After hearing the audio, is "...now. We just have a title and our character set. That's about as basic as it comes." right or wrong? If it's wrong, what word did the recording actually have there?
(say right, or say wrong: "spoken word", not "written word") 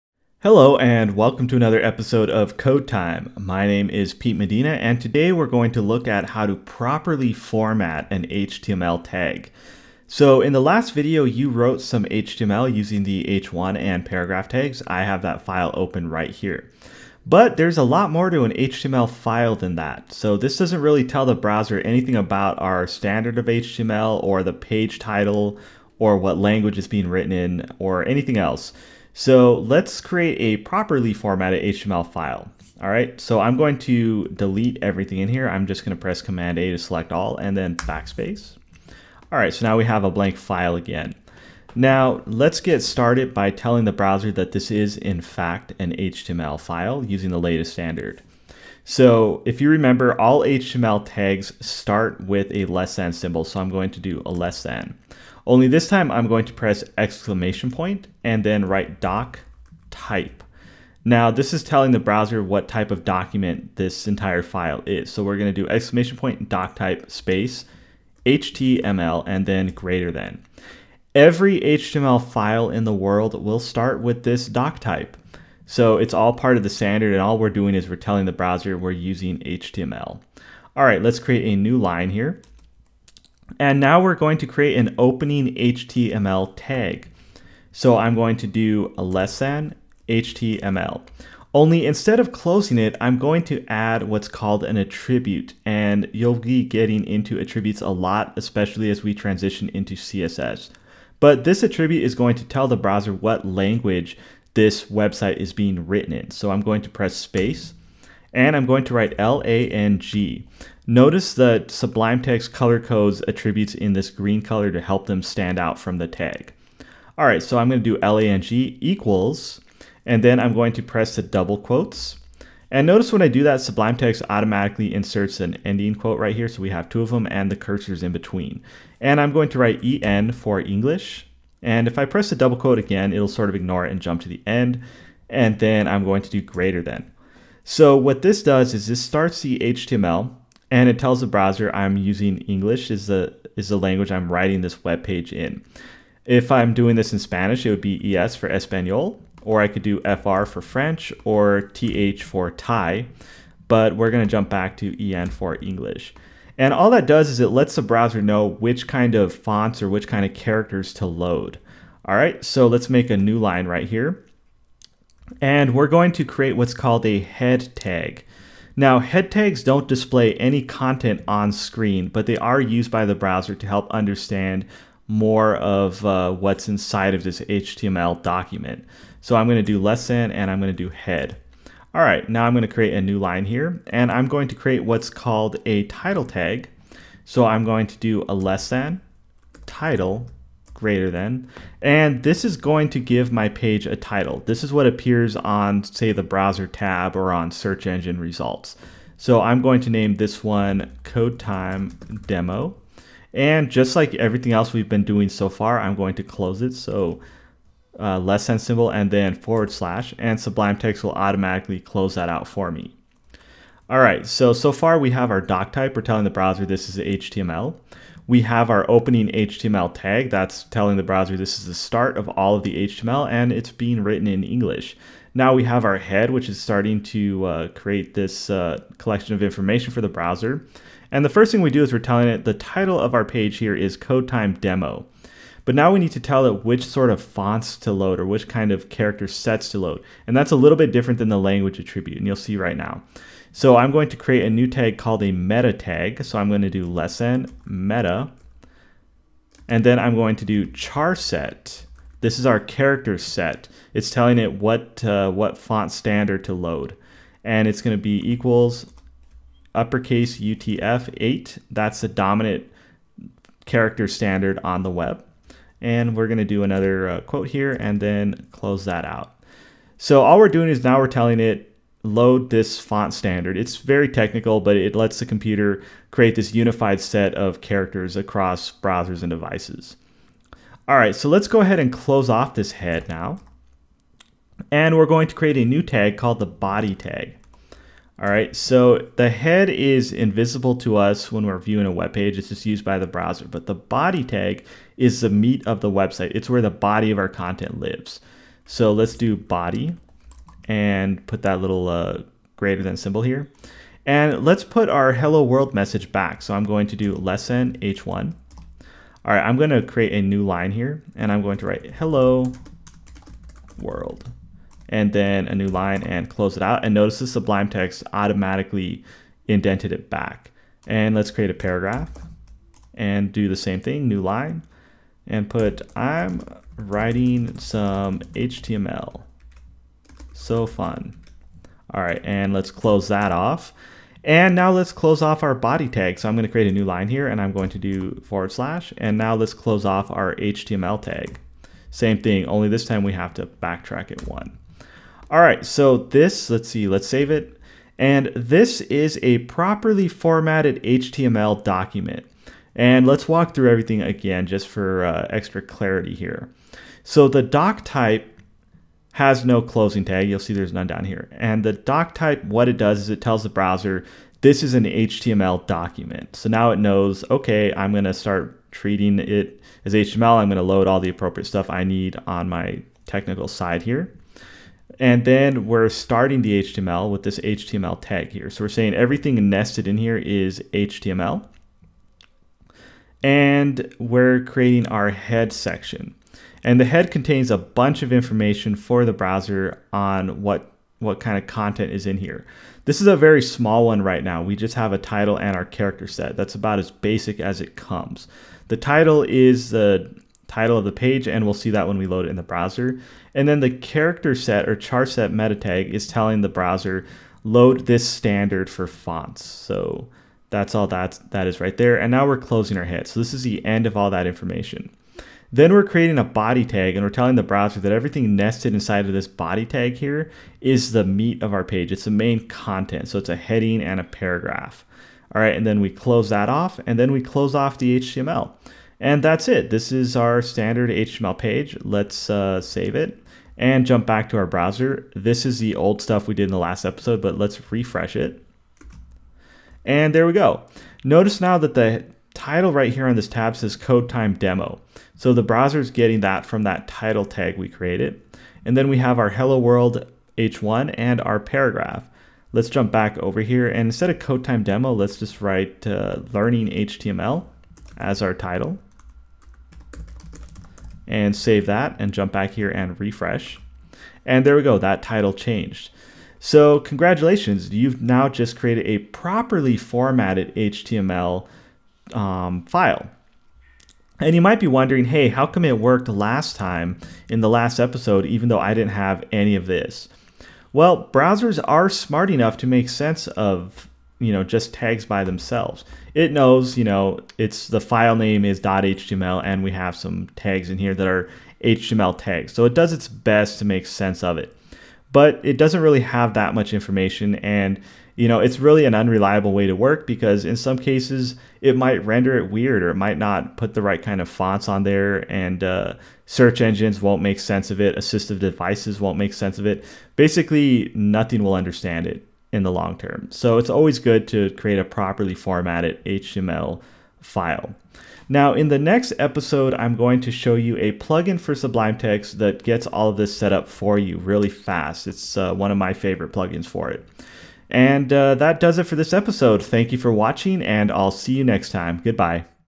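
right.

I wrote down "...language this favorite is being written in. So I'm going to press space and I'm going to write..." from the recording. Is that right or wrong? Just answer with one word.
wrong.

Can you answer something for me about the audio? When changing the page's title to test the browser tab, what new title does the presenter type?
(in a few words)
learning HTML.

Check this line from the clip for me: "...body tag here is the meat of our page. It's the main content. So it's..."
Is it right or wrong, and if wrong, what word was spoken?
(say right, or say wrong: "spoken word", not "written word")
right.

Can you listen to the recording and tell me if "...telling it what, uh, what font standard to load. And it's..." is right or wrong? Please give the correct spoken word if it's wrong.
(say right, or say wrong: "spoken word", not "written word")
right.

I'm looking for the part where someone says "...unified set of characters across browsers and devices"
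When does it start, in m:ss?
4:36.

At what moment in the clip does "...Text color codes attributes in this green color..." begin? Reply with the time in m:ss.
1:52.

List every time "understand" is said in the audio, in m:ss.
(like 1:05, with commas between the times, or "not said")
2:53, 8:31.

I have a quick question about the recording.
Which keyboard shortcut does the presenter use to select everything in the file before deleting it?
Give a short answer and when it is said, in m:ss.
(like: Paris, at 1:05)
Command A, at 0:36.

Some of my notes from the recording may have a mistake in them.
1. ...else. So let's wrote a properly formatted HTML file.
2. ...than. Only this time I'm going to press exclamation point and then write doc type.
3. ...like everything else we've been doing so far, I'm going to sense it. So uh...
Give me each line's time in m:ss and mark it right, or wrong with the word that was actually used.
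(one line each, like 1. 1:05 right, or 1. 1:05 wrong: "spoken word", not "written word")
1. 0:28 wrong: "create", not "wrote"
2. 0:54 right
3. 3:23 wrong: "close", not "sense".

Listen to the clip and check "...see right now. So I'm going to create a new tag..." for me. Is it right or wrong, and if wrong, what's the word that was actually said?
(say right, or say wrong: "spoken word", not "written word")
right.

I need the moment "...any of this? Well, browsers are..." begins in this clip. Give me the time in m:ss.
7:59.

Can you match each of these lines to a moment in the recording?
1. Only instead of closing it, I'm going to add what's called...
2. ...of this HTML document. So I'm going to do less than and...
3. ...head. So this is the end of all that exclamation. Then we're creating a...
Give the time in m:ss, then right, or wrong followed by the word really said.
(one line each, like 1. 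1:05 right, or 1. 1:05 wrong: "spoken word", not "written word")
1. 1:31 right
2. 2:57 right
3. 6:52 wrong: "information", not "exclamation".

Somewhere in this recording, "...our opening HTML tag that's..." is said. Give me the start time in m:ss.
3:38.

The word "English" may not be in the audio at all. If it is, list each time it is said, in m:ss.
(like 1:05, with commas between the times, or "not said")
2:10, 2:22, 2:35, 3:44.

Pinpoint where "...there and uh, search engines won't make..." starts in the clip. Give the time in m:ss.
8:24.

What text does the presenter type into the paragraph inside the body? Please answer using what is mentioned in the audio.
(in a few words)
I'm writing some HTML. So fun.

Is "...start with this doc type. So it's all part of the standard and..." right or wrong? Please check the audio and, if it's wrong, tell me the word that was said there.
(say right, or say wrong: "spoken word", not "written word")
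right.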